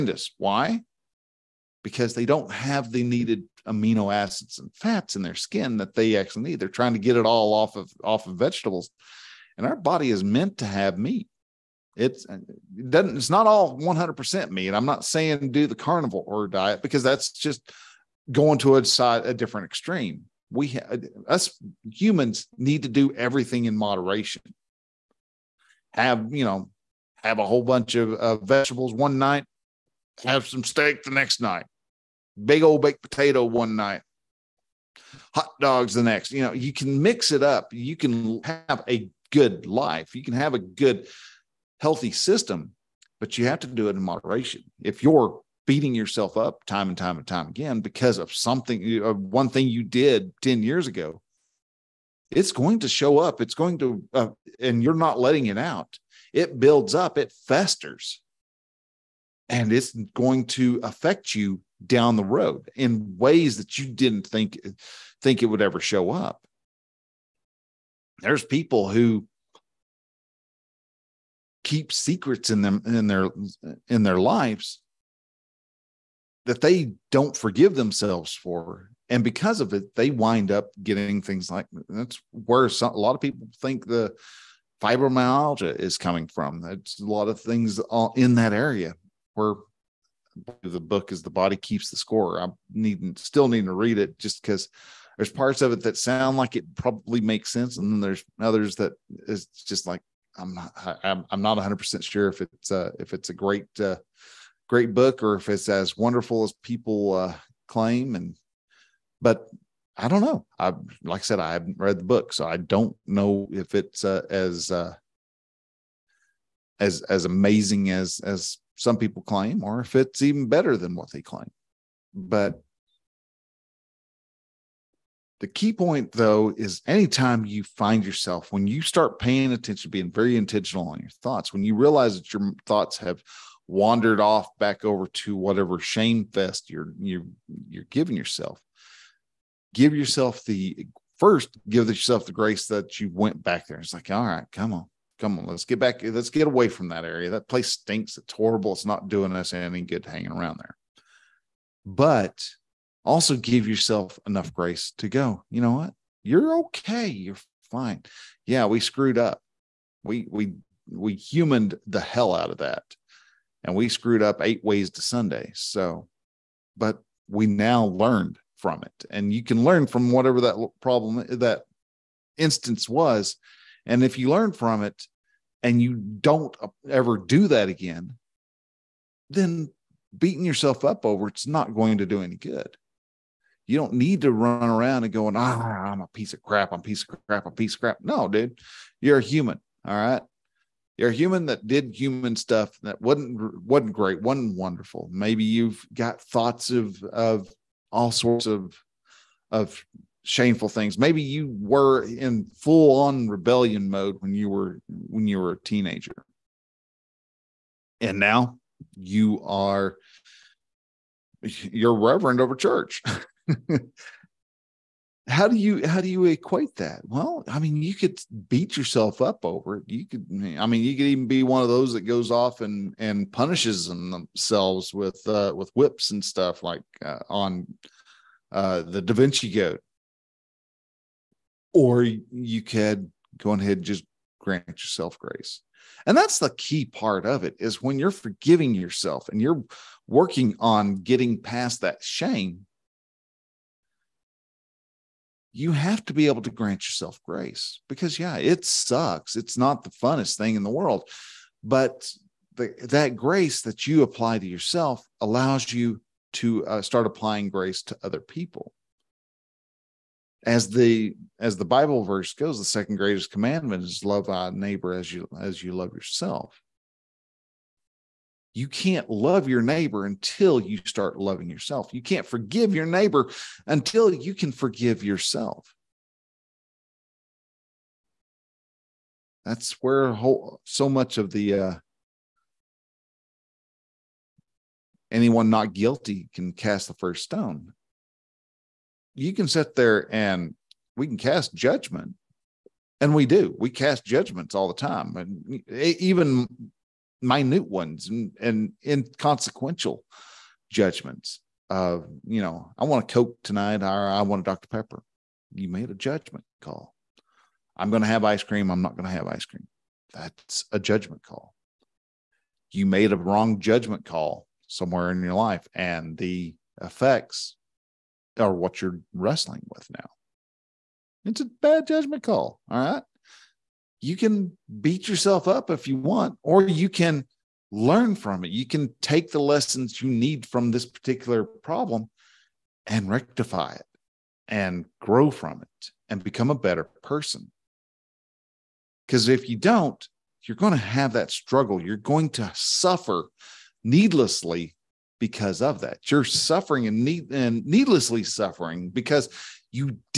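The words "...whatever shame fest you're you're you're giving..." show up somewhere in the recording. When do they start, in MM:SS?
02:15.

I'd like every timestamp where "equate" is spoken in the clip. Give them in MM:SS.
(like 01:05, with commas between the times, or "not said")
03:36.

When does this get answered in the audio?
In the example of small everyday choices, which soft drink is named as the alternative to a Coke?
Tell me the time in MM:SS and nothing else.
05:04.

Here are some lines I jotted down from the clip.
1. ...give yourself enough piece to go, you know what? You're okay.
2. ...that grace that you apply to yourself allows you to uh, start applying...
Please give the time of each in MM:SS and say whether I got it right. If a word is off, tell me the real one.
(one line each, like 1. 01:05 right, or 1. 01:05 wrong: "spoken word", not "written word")
1. 02:33 wrong: "grace", not "piece"
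2. 04:12 right.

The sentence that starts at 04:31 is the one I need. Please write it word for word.
You can't forgive your neighbor until you can forgive yourself.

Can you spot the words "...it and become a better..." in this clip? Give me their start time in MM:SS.
05:35.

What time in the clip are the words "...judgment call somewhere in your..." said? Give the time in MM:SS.
05:13.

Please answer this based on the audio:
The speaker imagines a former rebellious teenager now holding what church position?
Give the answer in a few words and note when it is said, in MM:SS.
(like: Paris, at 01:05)
reverend, at 03:31.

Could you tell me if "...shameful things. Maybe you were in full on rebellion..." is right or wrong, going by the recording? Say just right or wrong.
right.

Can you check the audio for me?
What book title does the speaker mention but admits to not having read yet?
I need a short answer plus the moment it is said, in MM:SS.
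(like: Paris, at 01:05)
The Body Keeps the Score, at 01:31.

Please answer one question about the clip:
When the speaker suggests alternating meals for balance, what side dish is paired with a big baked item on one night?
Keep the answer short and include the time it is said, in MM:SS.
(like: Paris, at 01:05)
baked potato, at 00:32.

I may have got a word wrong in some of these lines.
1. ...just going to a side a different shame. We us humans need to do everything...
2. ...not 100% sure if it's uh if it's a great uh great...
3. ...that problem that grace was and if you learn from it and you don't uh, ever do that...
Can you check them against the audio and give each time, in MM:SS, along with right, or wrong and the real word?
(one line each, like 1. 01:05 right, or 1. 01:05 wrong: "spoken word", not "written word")
1. 00:17 wrong: "extreme", not "shame"
2. 01:41 right
3. 02:50 wrong: "instance", not "grace".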